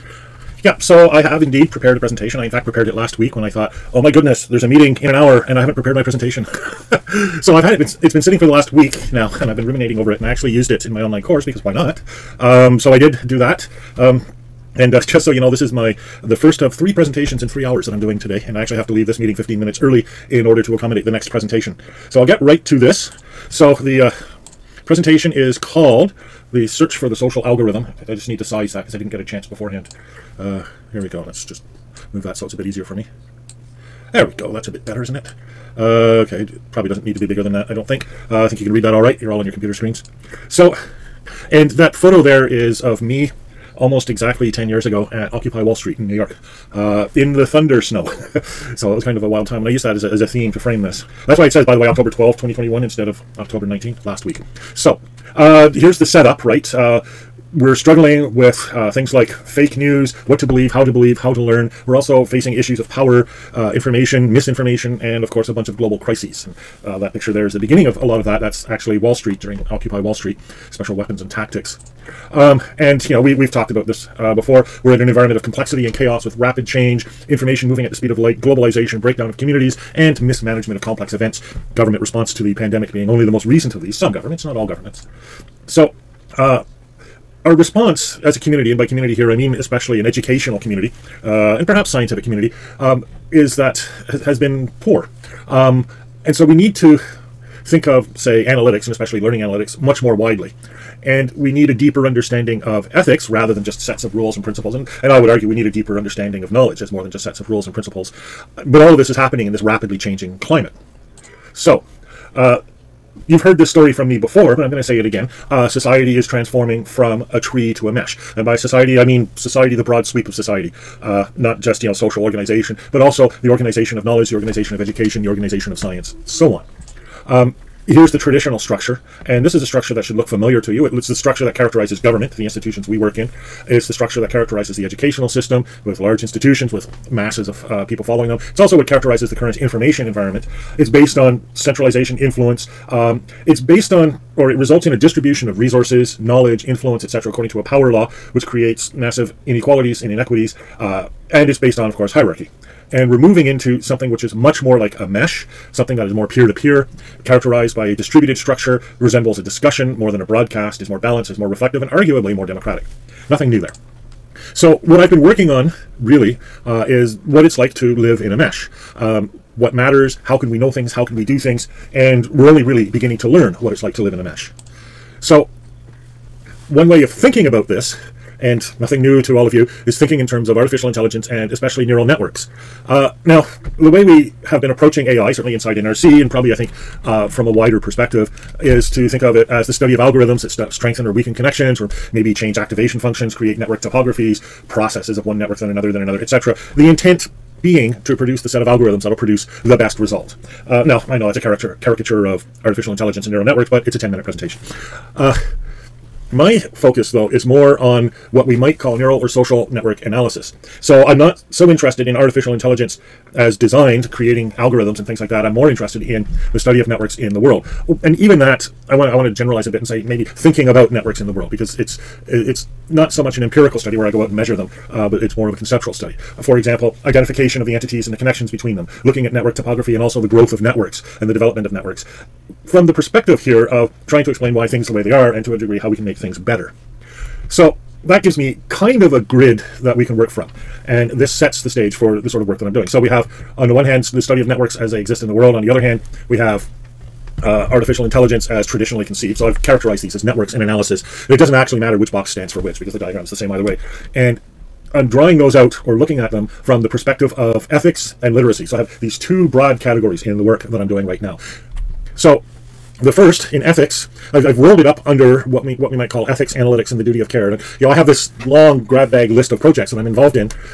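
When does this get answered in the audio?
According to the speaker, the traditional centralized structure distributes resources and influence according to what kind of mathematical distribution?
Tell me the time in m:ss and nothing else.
2:27.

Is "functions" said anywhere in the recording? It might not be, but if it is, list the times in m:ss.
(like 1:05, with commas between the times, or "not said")
3:12.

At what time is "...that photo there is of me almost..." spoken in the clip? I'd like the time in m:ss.
0:41.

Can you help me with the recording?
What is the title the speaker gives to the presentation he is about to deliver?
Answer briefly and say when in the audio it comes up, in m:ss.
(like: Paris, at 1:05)
The search for the social algorithm, at 0:26.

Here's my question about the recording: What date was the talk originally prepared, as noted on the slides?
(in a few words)
October 12, 2021.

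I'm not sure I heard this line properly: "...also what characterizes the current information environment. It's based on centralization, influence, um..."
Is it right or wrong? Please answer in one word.
right.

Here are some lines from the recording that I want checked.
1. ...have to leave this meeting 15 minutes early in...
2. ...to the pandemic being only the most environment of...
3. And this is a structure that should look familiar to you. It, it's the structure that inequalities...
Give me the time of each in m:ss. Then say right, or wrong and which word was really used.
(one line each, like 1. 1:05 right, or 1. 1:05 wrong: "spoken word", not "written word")
1. 0:18 right
2. 1:22 wrong: "recent", not "environment"
3. 2:09 wrong: "characterizes", not "inequalities".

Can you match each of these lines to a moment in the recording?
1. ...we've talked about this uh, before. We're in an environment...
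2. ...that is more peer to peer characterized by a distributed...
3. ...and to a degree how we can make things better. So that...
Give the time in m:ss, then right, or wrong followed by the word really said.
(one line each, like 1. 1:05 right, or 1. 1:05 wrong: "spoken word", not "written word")
1. 1:13 right
2. 2:35 right
3. 3:55 right.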